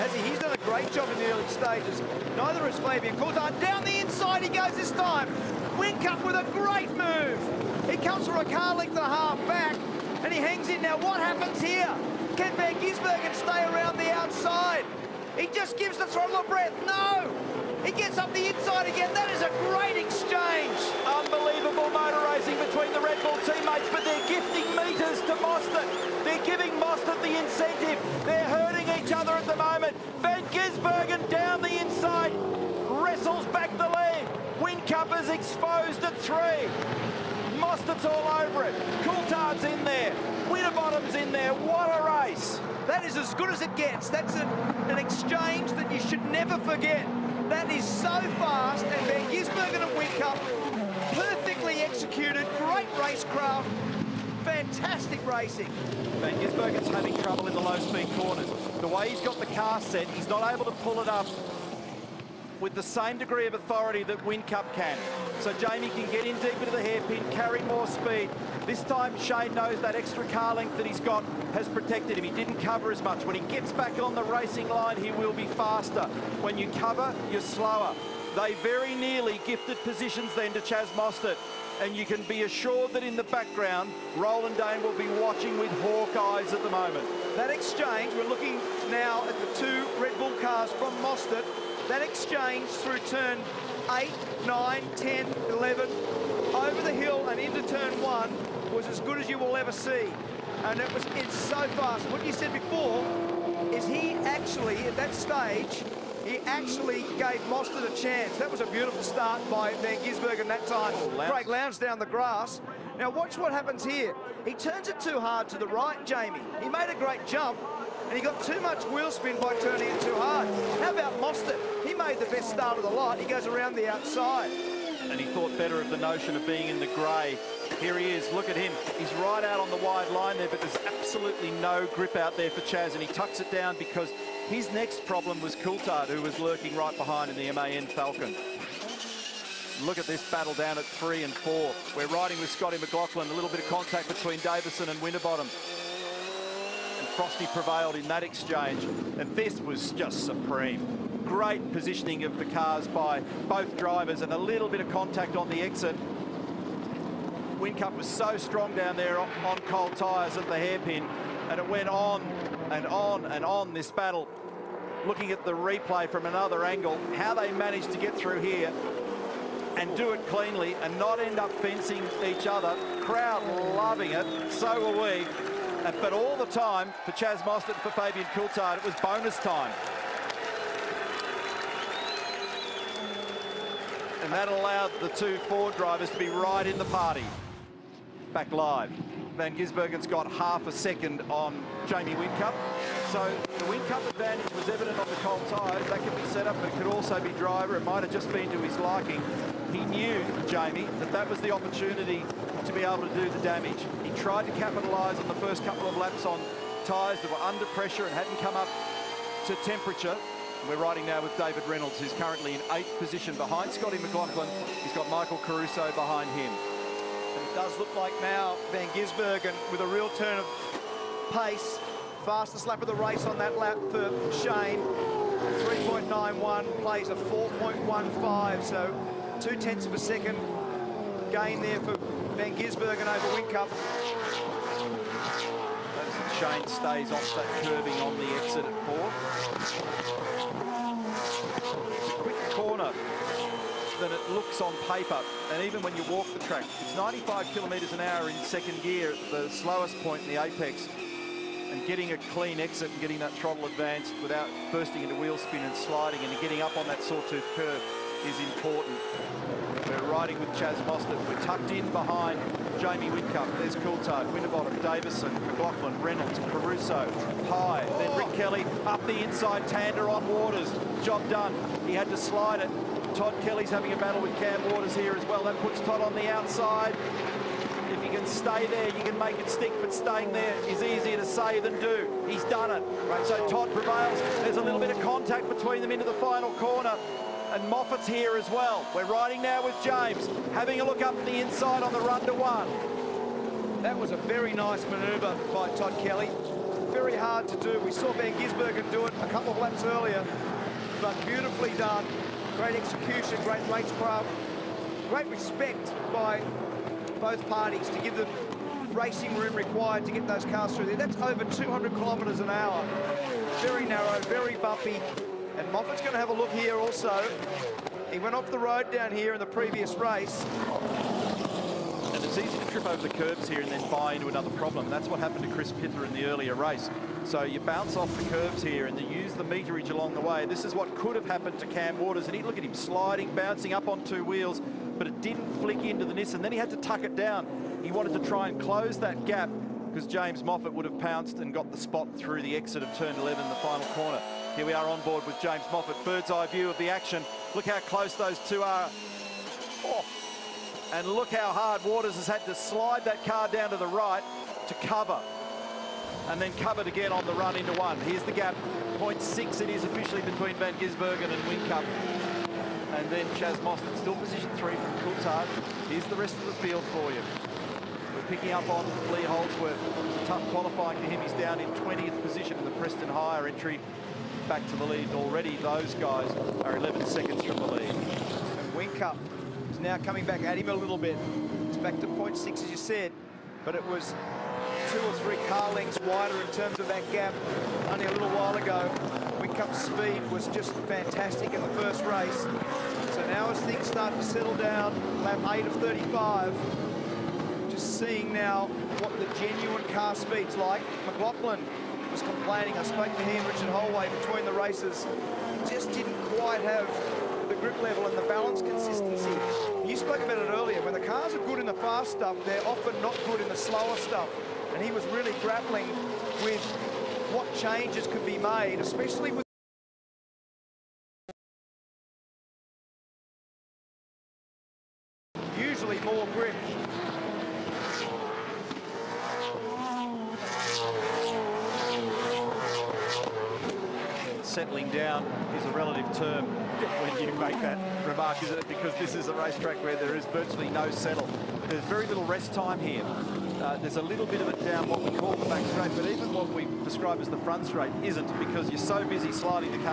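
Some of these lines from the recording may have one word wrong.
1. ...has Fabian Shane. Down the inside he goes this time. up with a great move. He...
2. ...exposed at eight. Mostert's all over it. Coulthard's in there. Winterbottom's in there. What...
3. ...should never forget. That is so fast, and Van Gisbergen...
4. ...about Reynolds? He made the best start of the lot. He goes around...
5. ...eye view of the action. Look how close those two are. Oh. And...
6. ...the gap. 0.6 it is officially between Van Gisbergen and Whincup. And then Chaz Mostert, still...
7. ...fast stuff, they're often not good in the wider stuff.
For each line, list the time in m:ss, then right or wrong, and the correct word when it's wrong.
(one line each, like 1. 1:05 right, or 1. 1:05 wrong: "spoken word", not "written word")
1. 0:02 wrong: "Coulthard", not "Shane"
2. 0:35 wrong: "three", not "eight"
3. 0:45 right
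4. 2:00 wrong: "Mostert", not "Reynolds"
5. 5:46 right
6. 5:58 right
7. 6:51 wrong: "slower", not "wider".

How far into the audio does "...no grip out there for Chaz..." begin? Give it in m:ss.
2:11.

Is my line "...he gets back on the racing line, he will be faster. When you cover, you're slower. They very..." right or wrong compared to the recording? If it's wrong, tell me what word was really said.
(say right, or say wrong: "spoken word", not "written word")
right.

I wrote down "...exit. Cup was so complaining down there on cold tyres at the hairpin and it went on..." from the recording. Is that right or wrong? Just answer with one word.
wrong.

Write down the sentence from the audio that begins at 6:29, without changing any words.
Whincup's speed was just fantastic in the first race.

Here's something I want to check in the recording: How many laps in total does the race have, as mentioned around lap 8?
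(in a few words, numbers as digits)
35.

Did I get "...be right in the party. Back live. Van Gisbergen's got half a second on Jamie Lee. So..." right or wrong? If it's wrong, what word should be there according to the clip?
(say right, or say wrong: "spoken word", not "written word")
wrong: "Whincup", not "Lee".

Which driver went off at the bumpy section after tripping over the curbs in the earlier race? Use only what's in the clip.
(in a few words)
Chris Pither.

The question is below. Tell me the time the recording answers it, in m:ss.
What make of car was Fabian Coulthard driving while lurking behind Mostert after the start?
2:17.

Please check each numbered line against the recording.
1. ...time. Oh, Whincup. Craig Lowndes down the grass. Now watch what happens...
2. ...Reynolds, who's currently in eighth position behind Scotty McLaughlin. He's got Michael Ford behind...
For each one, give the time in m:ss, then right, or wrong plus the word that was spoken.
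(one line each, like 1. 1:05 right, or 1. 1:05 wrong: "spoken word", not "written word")
1. 1:50 wrong: "Lounge", not "Whincup"
2. 3:31 wrong: "Caruso", not "Ford".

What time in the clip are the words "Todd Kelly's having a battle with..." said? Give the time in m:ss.
4:33.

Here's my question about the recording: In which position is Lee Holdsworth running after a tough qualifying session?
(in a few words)
20th.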